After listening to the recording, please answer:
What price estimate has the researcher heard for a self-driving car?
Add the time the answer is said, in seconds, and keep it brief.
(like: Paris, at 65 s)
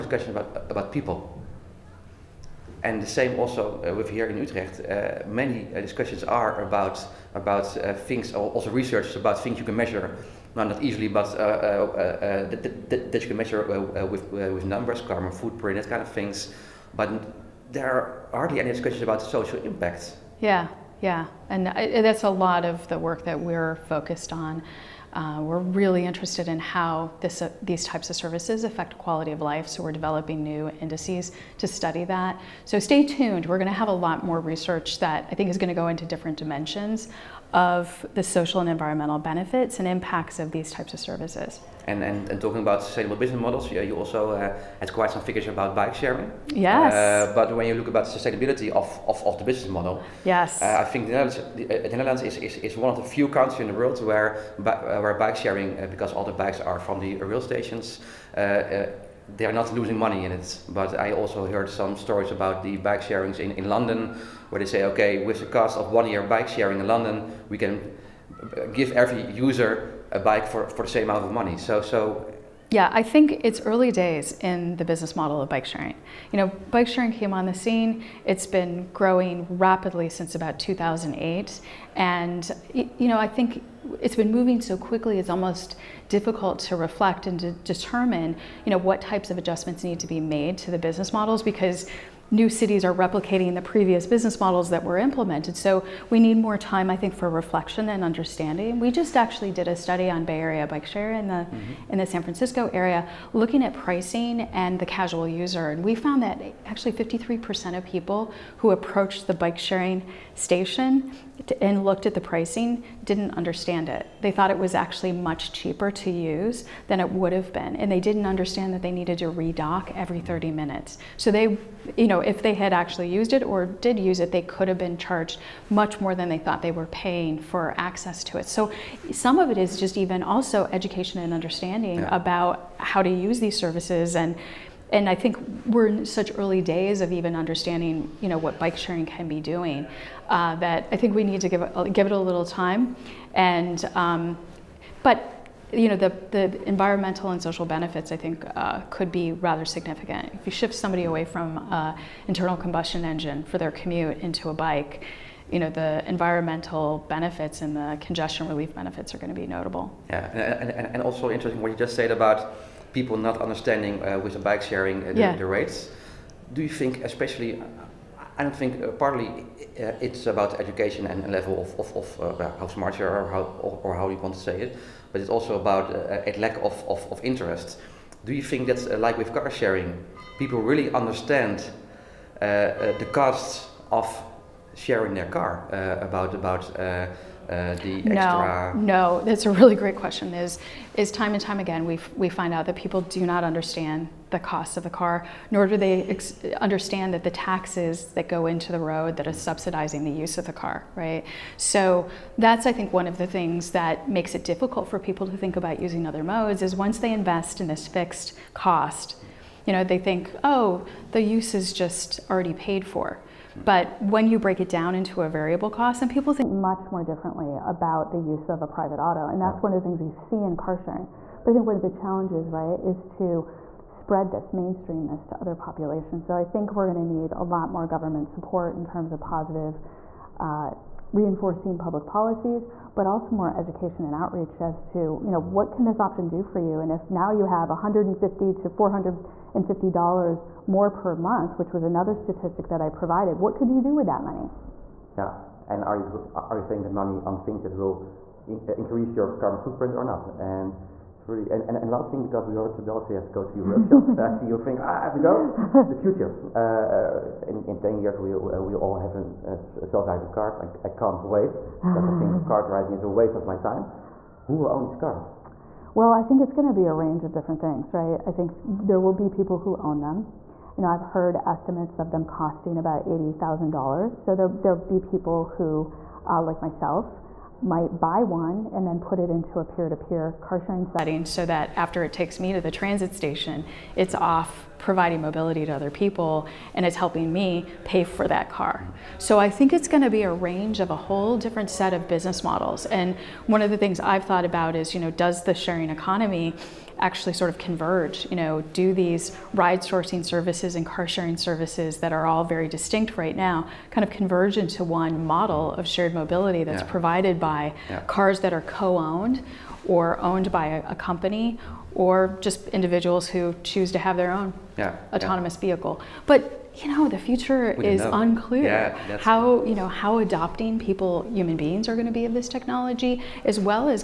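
$80,000, at 273 s.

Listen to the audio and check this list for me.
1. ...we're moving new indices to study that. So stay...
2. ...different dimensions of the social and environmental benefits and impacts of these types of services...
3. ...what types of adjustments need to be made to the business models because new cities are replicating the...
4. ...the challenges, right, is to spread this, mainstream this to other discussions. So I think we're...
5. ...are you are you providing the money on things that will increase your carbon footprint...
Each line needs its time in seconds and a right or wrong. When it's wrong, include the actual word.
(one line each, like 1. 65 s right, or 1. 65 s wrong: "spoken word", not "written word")
1. 29 s wrong: "developing", not "moving"
2. 36 s right
3. 88 s right
4. 221 s wrong: "populations", not "discussions"
5. 245 s wrong: "spending", not "providing".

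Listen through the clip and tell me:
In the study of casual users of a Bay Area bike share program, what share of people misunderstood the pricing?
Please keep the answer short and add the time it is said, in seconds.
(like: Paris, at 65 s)
53%, at 106 s.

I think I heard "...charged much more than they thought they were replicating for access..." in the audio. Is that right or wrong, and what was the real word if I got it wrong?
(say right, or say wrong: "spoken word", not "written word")
wrong: "paying", not "replicating".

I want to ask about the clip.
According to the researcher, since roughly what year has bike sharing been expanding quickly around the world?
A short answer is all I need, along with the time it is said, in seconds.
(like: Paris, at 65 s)
2008, at 80 s.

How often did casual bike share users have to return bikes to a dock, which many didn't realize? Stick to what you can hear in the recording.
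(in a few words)
every 30 minutes.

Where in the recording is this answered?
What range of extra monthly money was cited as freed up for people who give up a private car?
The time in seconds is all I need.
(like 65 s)
237 s.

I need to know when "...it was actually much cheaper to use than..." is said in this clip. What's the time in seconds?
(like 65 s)
114 s.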